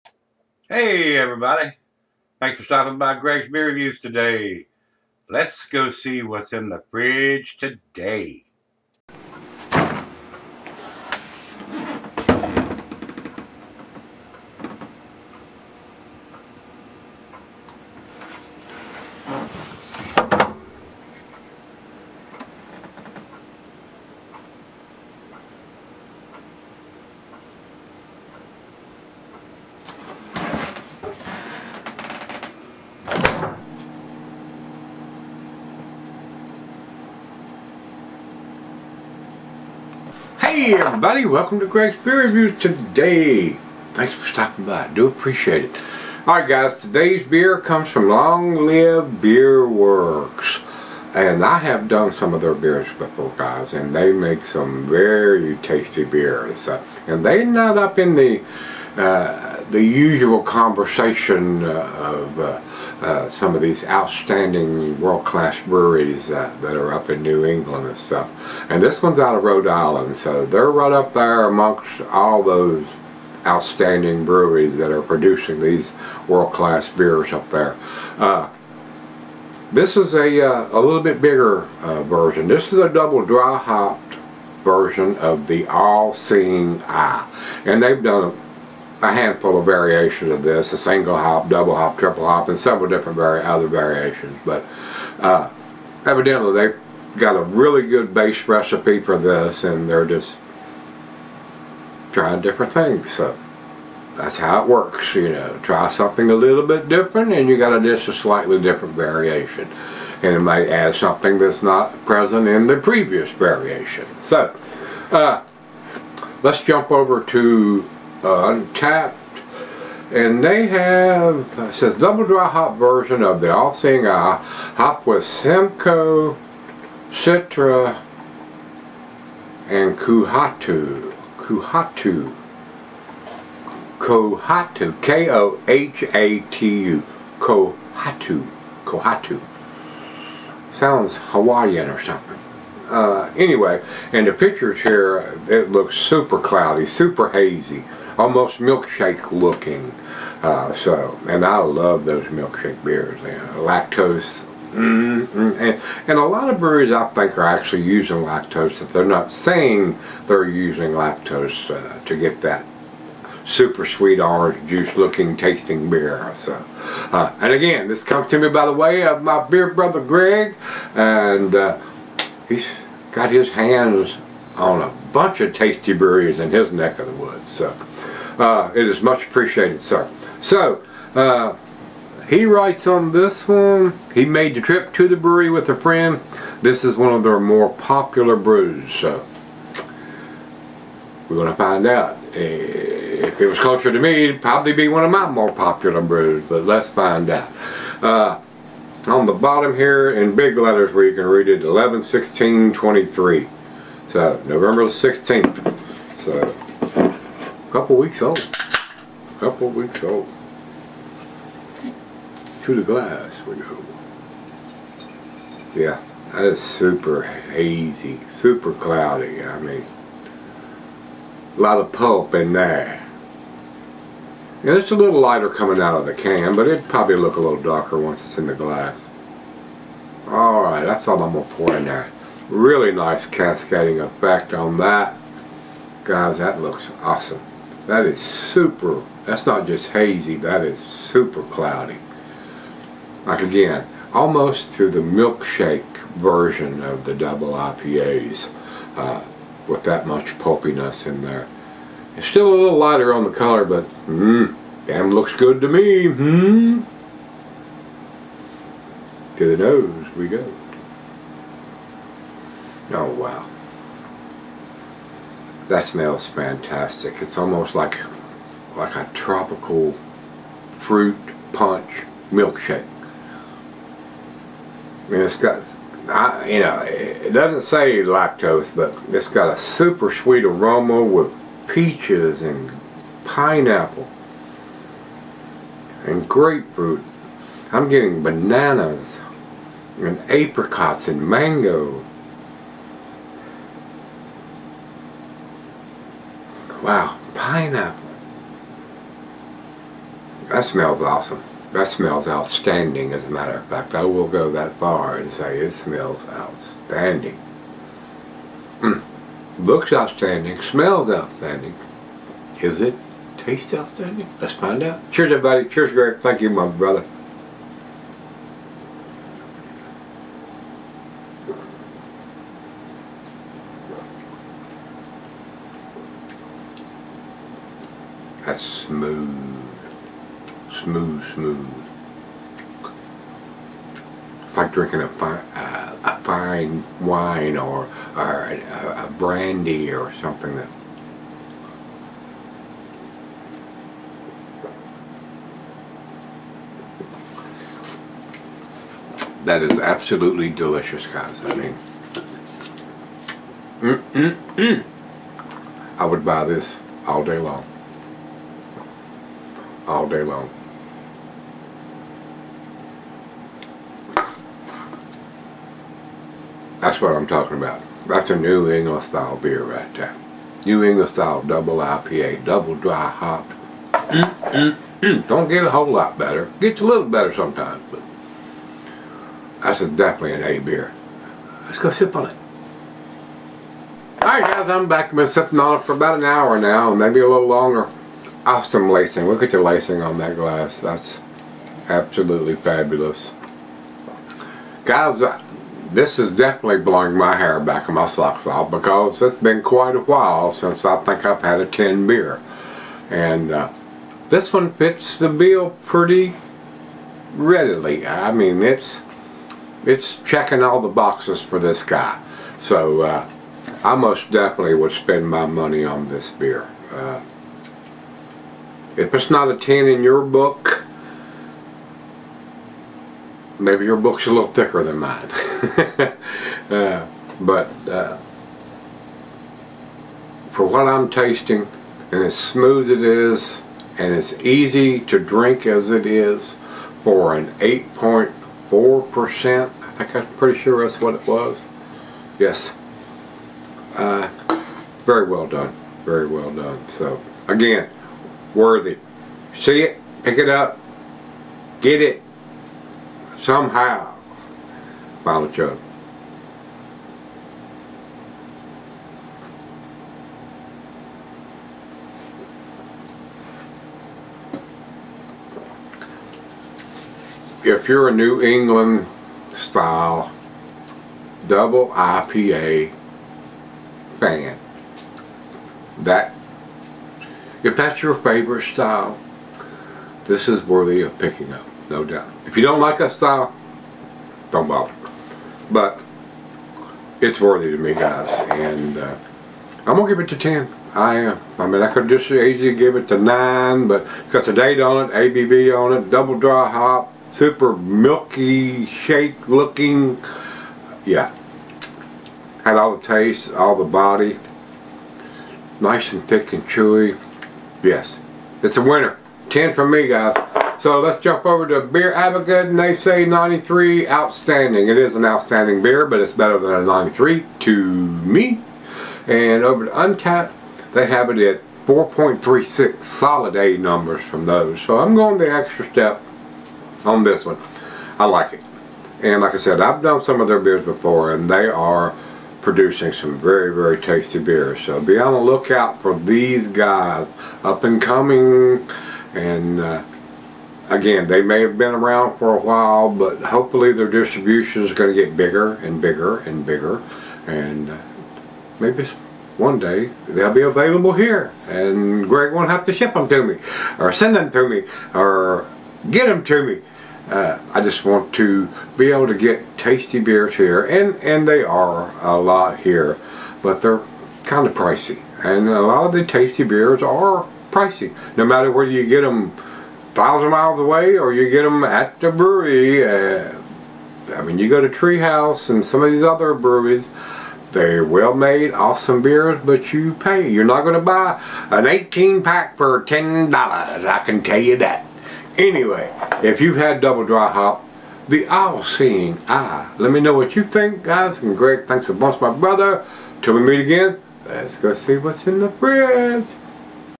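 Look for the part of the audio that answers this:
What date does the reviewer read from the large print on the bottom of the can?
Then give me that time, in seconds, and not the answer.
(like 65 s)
201 s.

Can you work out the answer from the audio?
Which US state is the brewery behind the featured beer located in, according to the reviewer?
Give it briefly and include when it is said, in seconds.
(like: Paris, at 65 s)
Rhode Island, at 69 s.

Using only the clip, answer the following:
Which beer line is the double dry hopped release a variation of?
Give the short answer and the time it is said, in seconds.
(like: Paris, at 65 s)
All Seeing Eye, at 85 s.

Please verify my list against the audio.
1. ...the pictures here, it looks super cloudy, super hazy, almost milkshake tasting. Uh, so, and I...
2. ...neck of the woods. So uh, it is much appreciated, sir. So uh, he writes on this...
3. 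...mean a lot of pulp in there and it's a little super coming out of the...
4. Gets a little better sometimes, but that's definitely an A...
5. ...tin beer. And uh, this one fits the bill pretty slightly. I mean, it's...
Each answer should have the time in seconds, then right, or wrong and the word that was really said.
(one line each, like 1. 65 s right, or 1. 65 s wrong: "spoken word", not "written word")
1. 144 s wrong: "looking", not "tasting"
2. 176 s right
3. 219 s wrong: "lighter", not "super"
4. 376 s right
5. 401 s wrong: "readily", not "slightly".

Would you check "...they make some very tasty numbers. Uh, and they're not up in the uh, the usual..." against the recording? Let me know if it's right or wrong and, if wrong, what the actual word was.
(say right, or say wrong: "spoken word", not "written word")
wrong: "beers", not "numbers".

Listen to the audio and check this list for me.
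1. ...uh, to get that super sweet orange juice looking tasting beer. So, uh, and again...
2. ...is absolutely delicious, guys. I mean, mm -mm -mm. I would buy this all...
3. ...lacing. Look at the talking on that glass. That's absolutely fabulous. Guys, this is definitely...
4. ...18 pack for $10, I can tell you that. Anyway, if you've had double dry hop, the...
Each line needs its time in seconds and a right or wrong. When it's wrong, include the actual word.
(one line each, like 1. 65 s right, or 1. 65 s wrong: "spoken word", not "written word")
1. 161 s right
2. 349 s right
3. 388 s wrong: "lacing", not "talking"
4. 581 s right.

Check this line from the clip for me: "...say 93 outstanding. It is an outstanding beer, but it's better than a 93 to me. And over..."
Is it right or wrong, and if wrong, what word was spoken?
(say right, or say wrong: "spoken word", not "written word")
right.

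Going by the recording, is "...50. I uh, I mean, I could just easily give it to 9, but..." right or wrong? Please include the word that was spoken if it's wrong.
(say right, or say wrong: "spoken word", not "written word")
wrong: "10", not "50".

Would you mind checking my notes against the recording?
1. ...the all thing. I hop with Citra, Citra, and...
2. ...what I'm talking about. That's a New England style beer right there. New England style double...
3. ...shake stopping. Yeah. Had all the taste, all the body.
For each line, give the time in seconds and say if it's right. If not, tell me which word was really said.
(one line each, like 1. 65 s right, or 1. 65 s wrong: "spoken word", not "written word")
1. 123 s wrong: "Simcoe", not "Citra"
2. 366 s right
3. 498 s wrong: "looking", not "stopping".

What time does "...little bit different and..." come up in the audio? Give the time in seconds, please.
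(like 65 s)
106 s.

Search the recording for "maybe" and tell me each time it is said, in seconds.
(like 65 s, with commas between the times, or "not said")
386 s, 423 s, 548 s.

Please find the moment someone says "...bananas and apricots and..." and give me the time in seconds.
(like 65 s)
288 s.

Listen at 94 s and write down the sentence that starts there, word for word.
But uh, evidently they got a really good base recipe for this and they're just trying different things.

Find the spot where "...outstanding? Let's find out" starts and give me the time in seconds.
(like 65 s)
313 s.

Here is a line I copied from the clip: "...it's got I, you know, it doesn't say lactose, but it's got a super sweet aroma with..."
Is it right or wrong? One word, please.
right.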